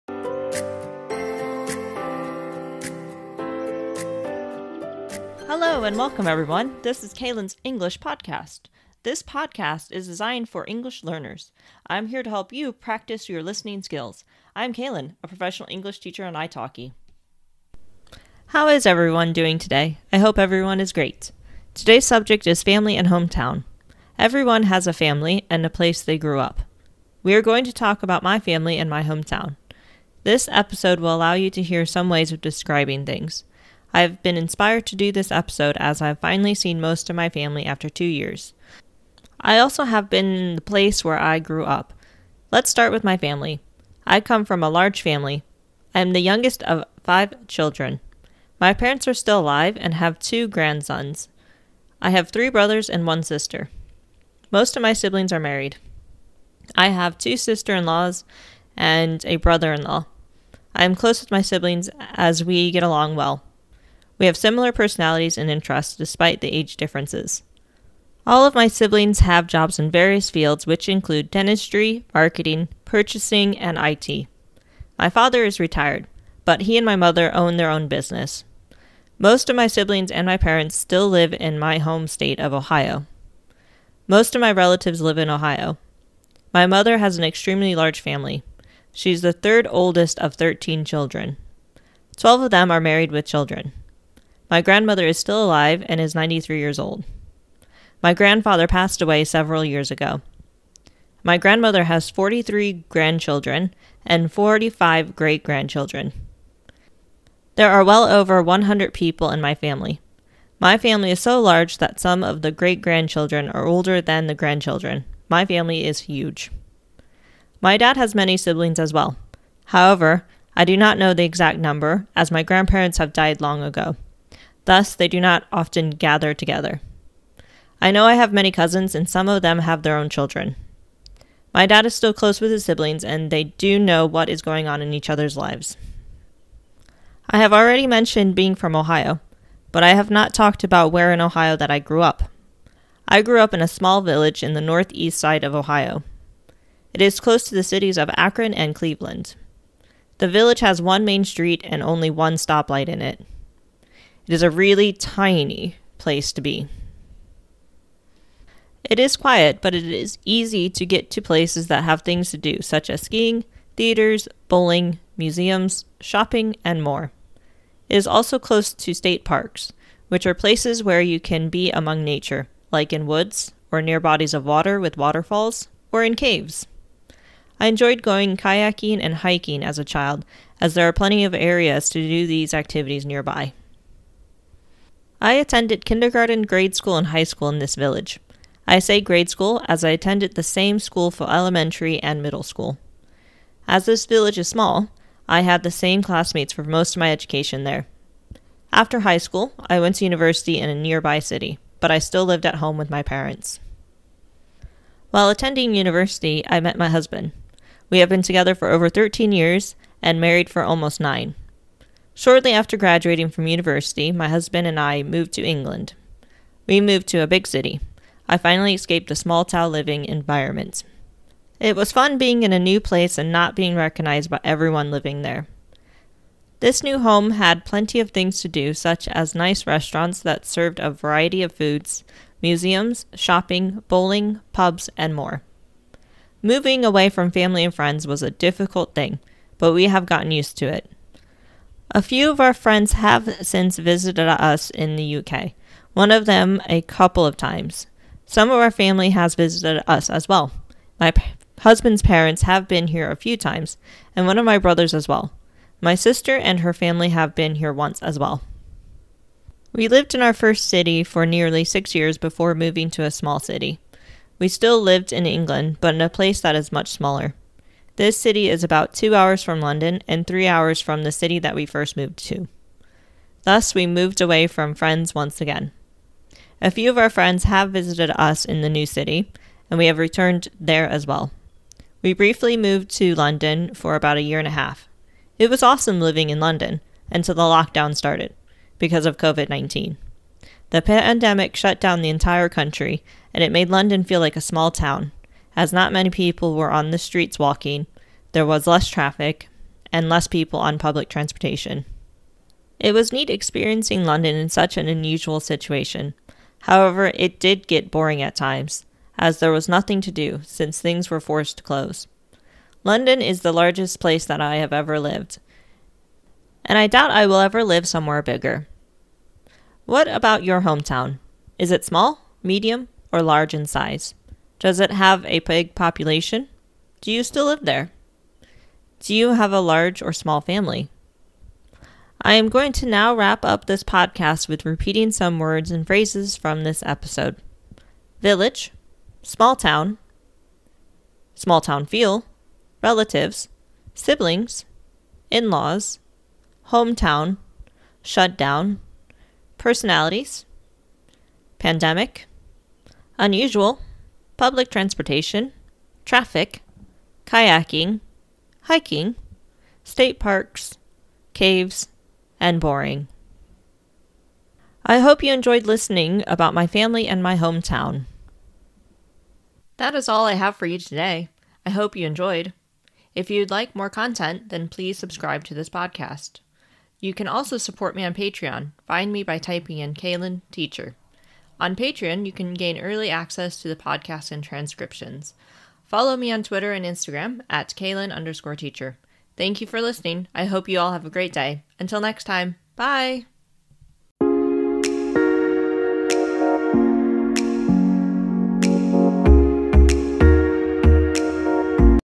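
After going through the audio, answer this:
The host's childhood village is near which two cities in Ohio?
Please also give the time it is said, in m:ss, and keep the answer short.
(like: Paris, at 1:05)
Akron and Cleveland, at 2:28.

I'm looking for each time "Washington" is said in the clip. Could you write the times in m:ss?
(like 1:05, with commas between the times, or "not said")
not said.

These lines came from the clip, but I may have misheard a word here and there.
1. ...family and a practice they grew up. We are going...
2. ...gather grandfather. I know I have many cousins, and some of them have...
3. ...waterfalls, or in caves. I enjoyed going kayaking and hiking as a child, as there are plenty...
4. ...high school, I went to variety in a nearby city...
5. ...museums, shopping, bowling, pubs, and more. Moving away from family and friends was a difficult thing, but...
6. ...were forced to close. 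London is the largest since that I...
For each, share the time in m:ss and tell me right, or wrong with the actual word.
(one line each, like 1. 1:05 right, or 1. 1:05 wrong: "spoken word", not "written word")
1. 0:24 wrong: "place", not "practice"
2. 2:05 wrong: "together", not "grandfather"
3. 2:54 right
4. 3:19 wrong: "university", not "variety"
5. 3:52 right
6. 5:11 wrong: "place", not "since".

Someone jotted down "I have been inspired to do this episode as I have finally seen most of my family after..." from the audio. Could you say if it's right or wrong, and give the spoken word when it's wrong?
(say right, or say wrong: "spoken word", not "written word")
right.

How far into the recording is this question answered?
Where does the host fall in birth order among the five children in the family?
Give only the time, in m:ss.
0:46.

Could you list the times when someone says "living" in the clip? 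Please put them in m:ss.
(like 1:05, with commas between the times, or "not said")
3:39, 3:44, 4:45.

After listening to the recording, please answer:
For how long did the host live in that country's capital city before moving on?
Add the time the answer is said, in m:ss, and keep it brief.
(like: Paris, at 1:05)
a year and a half, at 4:44.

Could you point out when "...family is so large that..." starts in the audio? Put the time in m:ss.
1:50.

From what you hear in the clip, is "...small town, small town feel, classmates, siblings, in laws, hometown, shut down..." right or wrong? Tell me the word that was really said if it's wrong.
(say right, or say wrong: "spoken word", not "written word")
wrong: "relatives", not "classmates".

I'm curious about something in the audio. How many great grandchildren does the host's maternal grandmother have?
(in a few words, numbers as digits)
45.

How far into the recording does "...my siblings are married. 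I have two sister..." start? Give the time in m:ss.
0:54.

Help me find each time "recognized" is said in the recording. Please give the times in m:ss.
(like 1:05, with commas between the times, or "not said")
3:43.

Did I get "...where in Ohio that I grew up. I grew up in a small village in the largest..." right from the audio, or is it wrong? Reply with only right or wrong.
wrong.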